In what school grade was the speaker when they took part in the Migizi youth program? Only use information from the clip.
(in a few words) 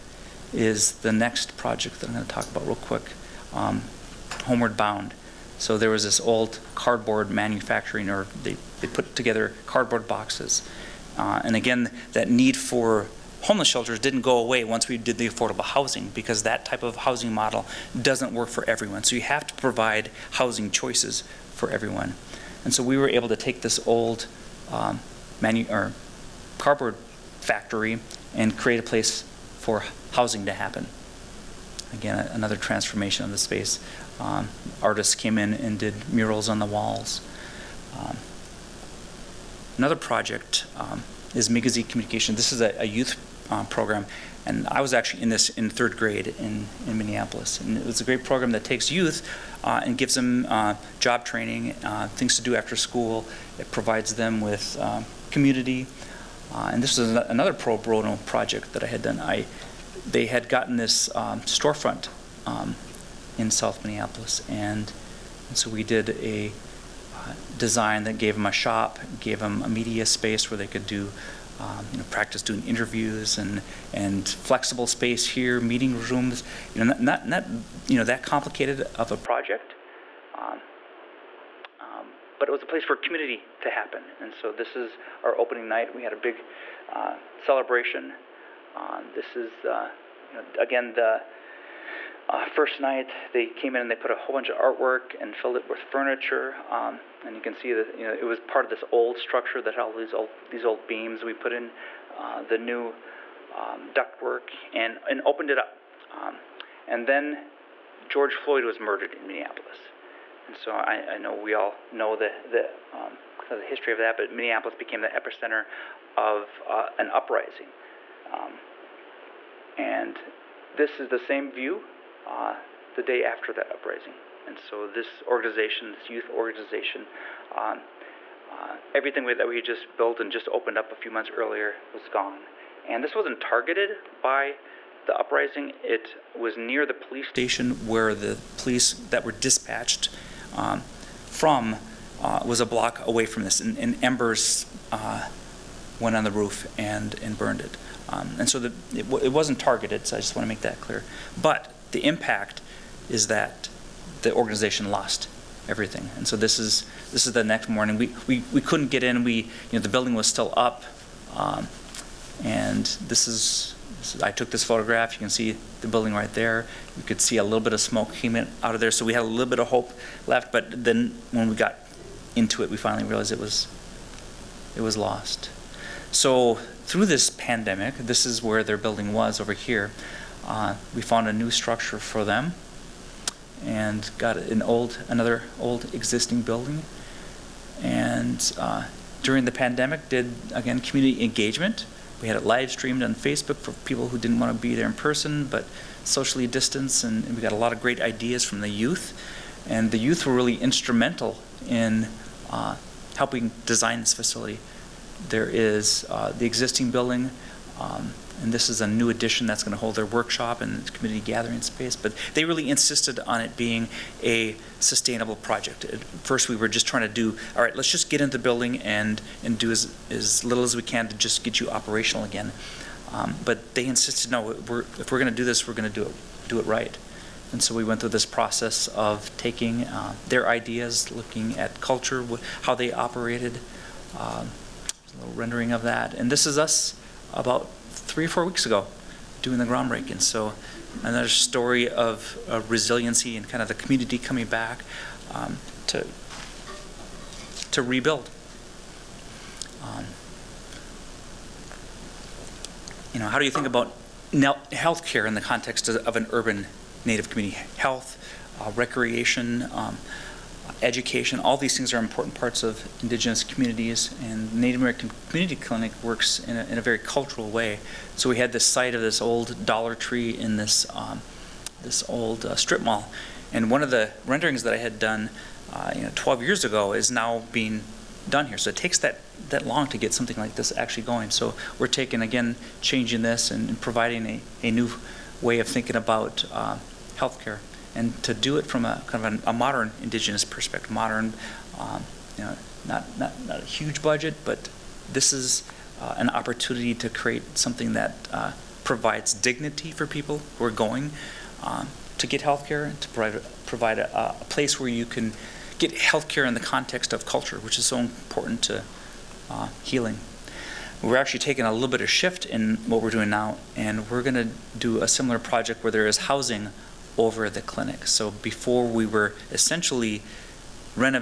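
Third grade.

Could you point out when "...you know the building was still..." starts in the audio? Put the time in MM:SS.
02:39.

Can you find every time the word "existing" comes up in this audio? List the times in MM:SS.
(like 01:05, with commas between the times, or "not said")
03:05, 03:26.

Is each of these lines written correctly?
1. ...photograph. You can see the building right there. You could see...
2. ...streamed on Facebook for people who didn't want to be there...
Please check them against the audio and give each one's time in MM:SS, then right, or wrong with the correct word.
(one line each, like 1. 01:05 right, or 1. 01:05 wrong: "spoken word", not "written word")
1. 02:44 right
2. 03:12 right.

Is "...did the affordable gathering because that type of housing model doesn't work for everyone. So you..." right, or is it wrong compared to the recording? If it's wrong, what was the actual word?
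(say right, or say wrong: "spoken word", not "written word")
wrong: "housing", not "gathering".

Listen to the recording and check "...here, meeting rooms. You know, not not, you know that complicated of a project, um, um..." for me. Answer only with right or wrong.
right.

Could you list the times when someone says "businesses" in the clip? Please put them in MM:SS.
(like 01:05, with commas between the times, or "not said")
not said.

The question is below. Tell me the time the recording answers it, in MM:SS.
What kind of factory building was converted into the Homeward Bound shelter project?
00:26.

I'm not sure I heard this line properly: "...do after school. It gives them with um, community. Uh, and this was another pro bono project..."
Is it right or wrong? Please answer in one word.
wrong.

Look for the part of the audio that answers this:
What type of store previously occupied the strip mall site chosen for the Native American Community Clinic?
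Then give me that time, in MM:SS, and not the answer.
04:29.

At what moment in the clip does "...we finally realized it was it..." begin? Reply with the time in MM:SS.
02:52.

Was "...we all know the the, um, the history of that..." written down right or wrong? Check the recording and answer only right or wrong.
right.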